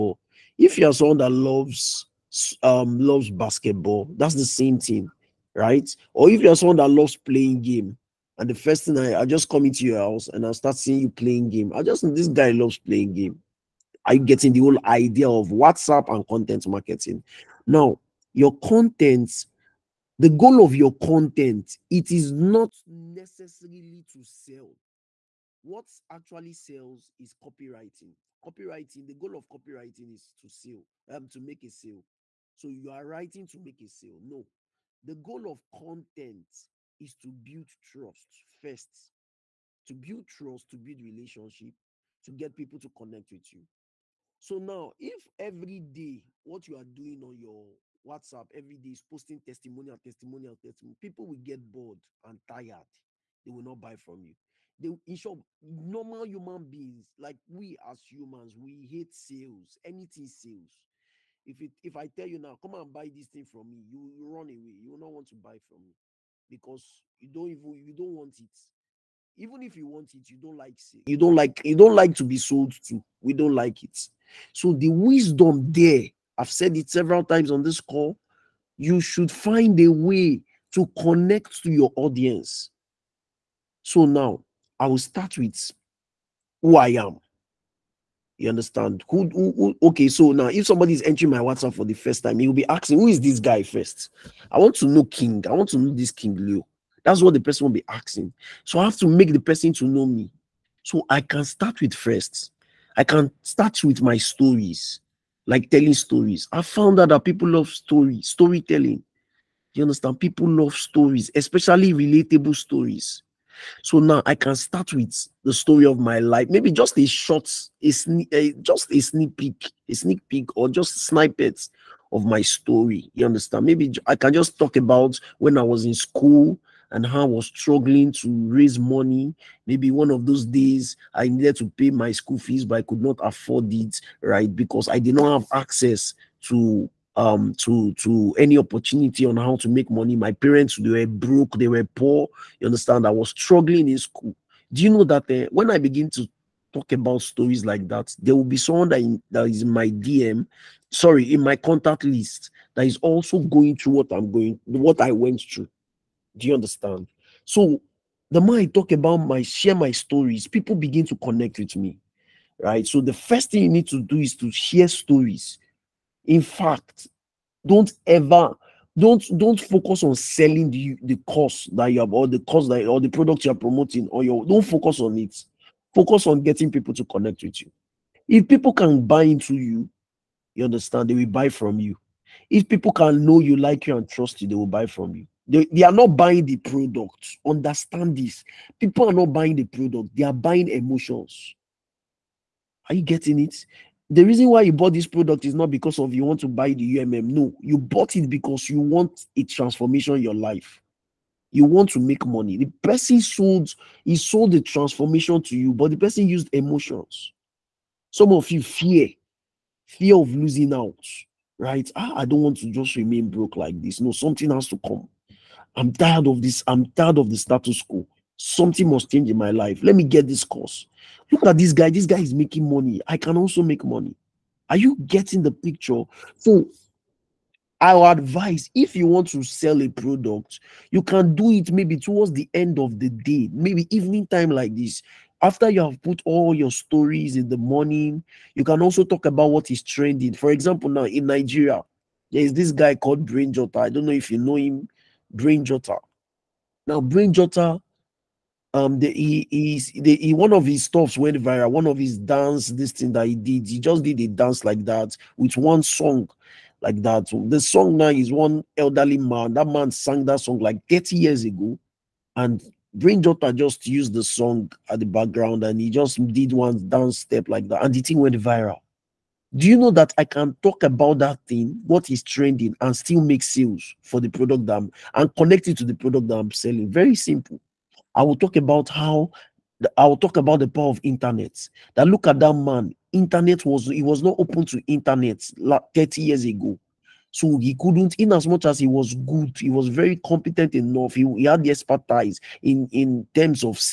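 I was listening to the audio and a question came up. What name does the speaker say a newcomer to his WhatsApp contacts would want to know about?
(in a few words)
King Leo.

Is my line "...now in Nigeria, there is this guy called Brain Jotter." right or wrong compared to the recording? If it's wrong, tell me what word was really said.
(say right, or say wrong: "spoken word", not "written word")
right.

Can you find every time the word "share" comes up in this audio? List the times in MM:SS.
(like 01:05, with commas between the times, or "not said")
02:39, 02:44.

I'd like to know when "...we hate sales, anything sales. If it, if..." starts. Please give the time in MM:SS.
00:58.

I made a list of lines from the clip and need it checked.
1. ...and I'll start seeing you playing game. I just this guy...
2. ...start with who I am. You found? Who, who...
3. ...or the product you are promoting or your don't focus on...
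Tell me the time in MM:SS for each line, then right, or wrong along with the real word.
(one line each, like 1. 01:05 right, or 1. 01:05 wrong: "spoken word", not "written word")
1. 00:10 right
2. 01:24 wrong: "understand", not "found"
3. 02:52 right.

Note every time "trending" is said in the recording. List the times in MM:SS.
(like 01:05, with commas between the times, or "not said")
03:59, 04:32.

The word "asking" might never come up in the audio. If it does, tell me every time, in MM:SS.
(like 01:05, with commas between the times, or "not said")
01:32, 01:37.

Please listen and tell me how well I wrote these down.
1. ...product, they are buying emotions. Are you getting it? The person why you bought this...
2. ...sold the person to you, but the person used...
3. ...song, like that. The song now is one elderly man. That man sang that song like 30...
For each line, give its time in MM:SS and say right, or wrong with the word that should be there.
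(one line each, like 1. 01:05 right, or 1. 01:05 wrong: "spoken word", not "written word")
1. 03:09 wrong: "reason", not "person"
2. 03:24 wrong: "transformation", not "person"
3. 04:15 right.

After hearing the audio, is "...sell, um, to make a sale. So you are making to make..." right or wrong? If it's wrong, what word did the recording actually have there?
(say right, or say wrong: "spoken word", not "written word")
wrong: "writing", not "making".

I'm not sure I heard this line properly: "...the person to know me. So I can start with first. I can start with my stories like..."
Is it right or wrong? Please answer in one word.
right.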